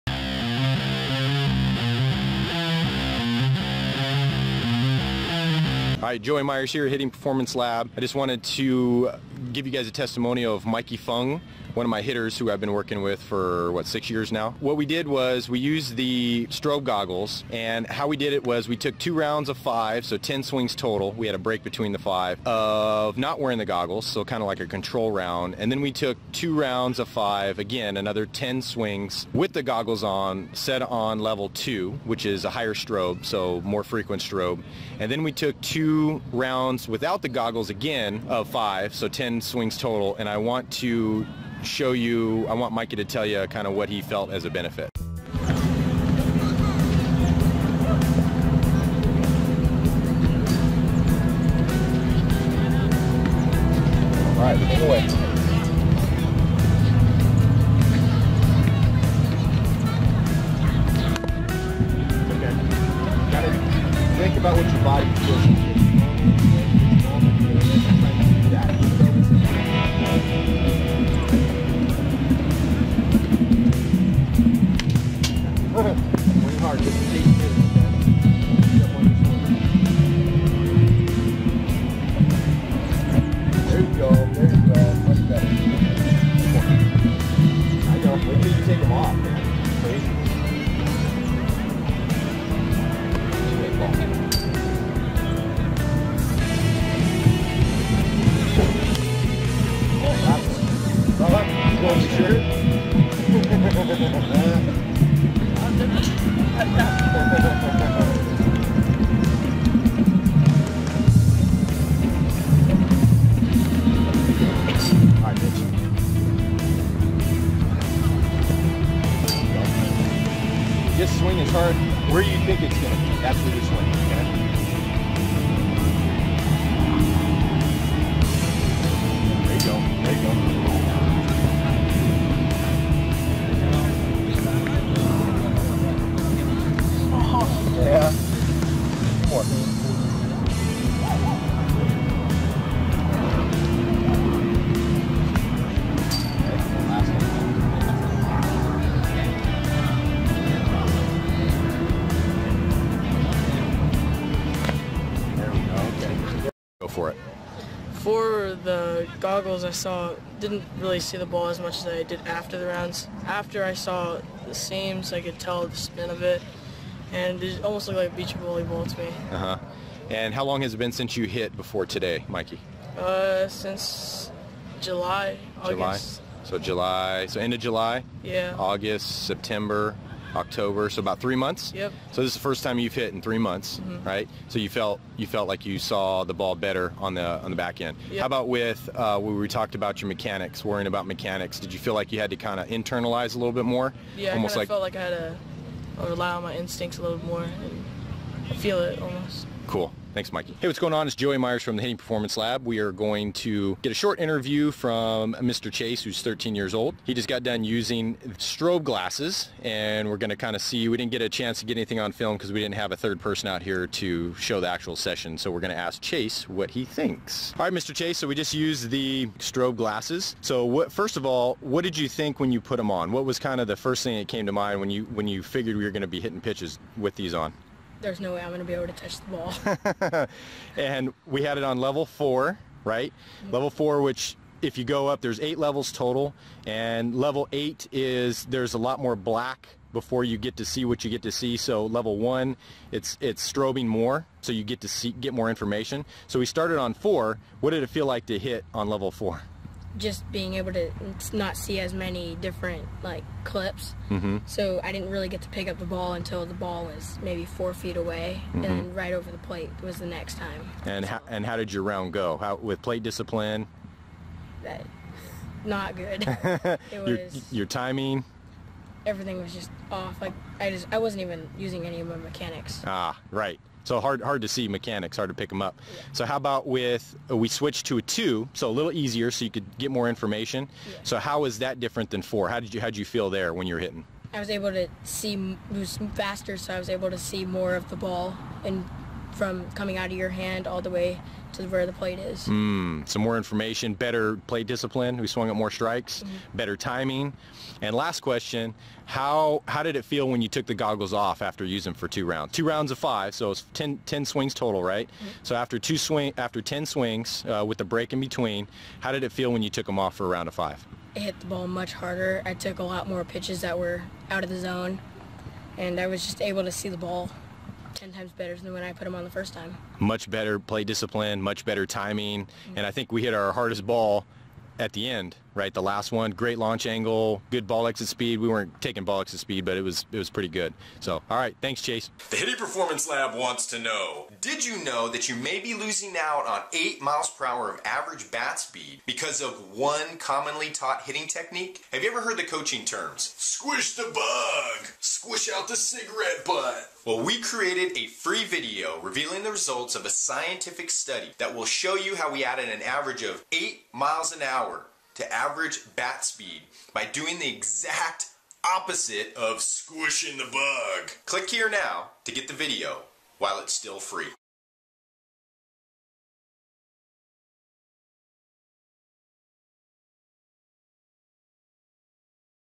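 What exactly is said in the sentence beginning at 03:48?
there's no way I'm going to be able to touch the ball.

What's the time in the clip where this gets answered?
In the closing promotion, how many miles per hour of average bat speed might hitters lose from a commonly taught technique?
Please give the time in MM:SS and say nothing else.
05:36.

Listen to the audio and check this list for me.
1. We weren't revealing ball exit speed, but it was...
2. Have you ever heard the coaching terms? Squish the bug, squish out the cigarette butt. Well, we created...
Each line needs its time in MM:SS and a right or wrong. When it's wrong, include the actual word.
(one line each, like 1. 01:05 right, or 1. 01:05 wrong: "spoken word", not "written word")
1. 05:28 wrong: "taking", not "revealing"
2. 05:41 right.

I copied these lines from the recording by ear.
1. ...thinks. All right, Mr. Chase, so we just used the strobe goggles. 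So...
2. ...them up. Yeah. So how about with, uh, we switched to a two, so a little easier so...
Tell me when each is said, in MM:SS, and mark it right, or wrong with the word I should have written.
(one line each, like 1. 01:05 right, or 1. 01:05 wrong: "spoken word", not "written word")
1. 03:36 wrong: "glasses", not "goggles"
2. 04:35 right.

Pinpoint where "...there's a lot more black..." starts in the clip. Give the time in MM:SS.
03:58.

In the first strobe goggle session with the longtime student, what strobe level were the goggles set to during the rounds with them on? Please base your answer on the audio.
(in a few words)
level 2.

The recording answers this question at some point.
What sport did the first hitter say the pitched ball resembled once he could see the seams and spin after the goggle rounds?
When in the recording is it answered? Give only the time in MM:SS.
02:48.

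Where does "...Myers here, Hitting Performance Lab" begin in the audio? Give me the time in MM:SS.
00:06.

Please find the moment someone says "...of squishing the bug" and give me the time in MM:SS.
05:59.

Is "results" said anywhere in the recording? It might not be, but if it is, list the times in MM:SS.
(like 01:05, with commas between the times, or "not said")
05:49.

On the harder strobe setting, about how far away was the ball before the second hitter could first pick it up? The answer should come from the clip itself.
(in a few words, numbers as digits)
4 feet.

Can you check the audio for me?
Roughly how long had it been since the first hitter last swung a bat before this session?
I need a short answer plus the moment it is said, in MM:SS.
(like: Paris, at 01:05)
about 3 months, at 03:00.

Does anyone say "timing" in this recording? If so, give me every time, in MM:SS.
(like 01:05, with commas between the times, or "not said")
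04:27, 04:56, 05:21.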